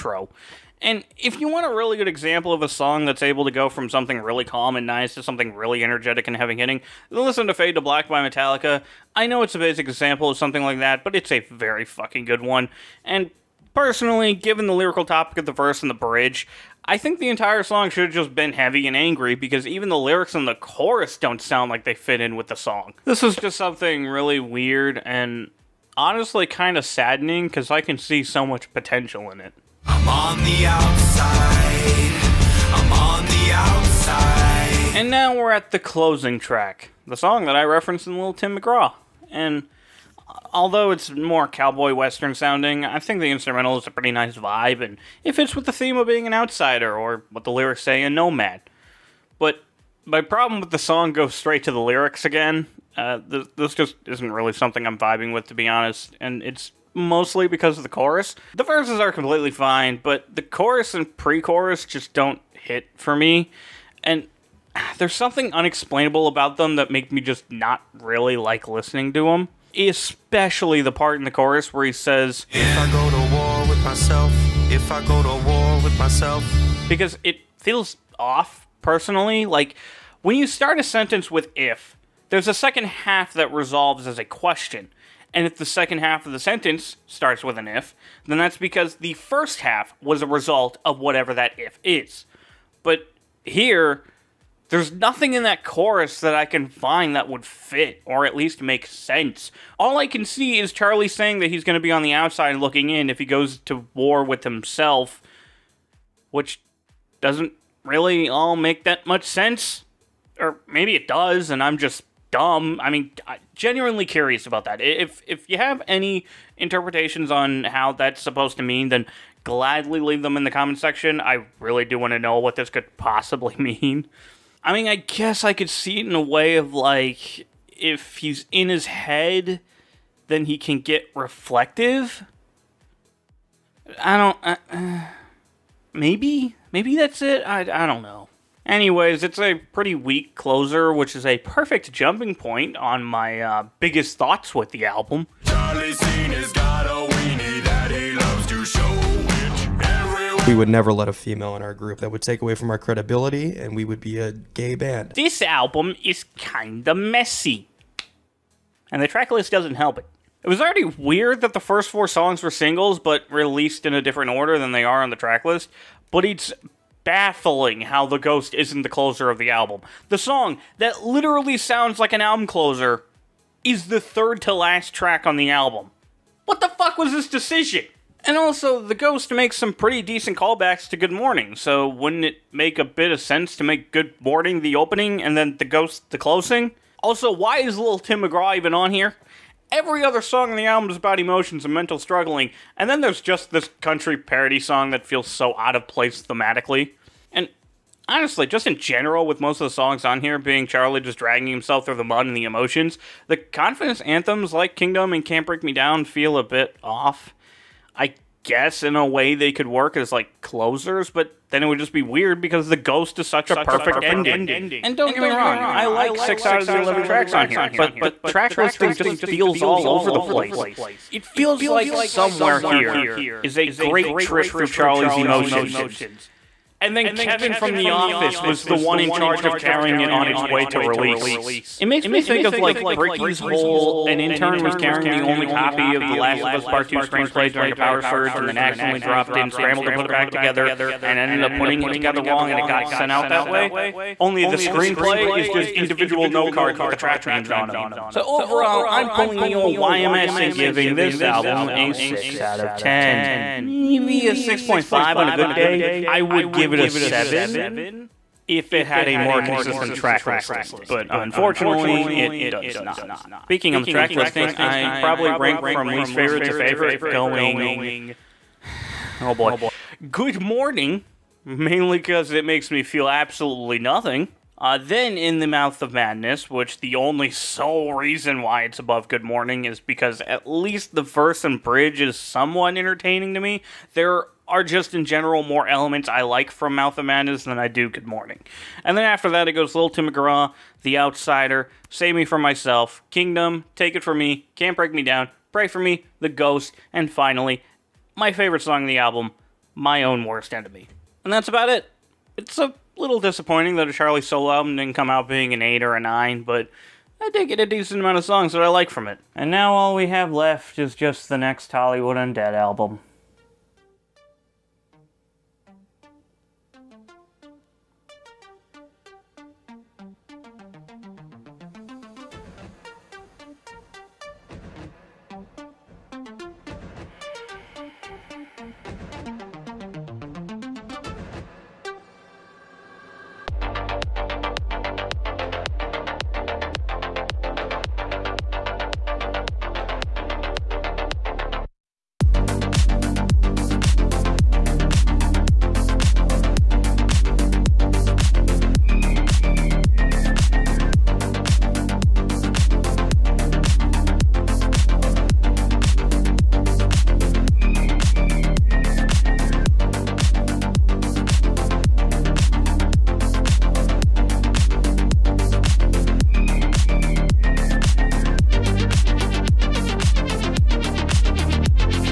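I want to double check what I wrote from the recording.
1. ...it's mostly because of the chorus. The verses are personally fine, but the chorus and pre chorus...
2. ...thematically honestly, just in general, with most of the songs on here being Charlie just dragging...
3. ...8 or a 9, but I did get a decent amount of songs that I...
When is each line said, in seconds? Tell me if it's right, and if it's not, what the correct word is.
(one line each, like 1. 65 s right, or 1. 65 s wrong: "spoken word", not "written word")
1. 56 s wrong: "completely", not "personally"
2. 196 s right
3. 305 s right.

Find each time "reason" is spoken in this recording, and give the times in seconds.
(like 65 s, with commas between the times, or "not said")
277 s.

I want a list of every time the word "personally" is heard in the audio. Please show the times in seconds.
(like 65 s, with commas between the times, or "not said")
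13 s, 78 s.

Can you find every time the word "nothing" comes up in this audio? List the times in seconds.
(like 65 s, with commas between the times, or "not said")
94 s, 273 s.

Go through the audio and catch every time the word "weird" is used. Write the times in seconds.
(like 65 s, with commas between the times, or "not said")
24 s, 160 s, 212 s.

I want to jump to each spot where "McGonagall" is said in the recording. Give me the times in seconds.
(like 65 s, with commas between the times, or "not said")
not said.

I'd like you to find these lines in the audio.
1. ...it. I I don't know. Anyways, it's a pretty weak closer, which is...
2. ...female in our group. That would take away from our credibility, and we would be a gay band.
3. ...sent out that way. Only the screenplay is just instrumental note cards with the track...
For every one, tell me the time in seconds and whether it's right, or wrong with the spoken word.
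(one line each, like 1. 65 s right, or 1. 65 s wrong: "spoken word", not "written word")
1. 137 s right
2. 151 s right
3. 242 s wrong: "individual", not "instrumental".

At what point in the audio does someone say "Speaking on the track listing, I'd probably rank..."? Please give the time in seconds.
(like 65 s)
263 s.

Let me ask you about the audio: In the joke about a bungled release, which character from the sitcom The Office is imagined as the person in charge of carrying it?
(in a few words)
Kevin.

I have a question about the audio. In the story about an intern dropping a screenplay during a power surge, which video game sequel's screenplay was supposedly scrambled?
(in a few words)
The Last of Us Part 2.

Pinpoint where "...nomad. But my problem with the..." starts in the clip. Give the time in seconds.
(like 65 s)
48 s.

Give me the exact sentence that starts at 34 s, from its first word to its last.
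And now we're at the closing track, the song that I referenced in Little Tim McGraw.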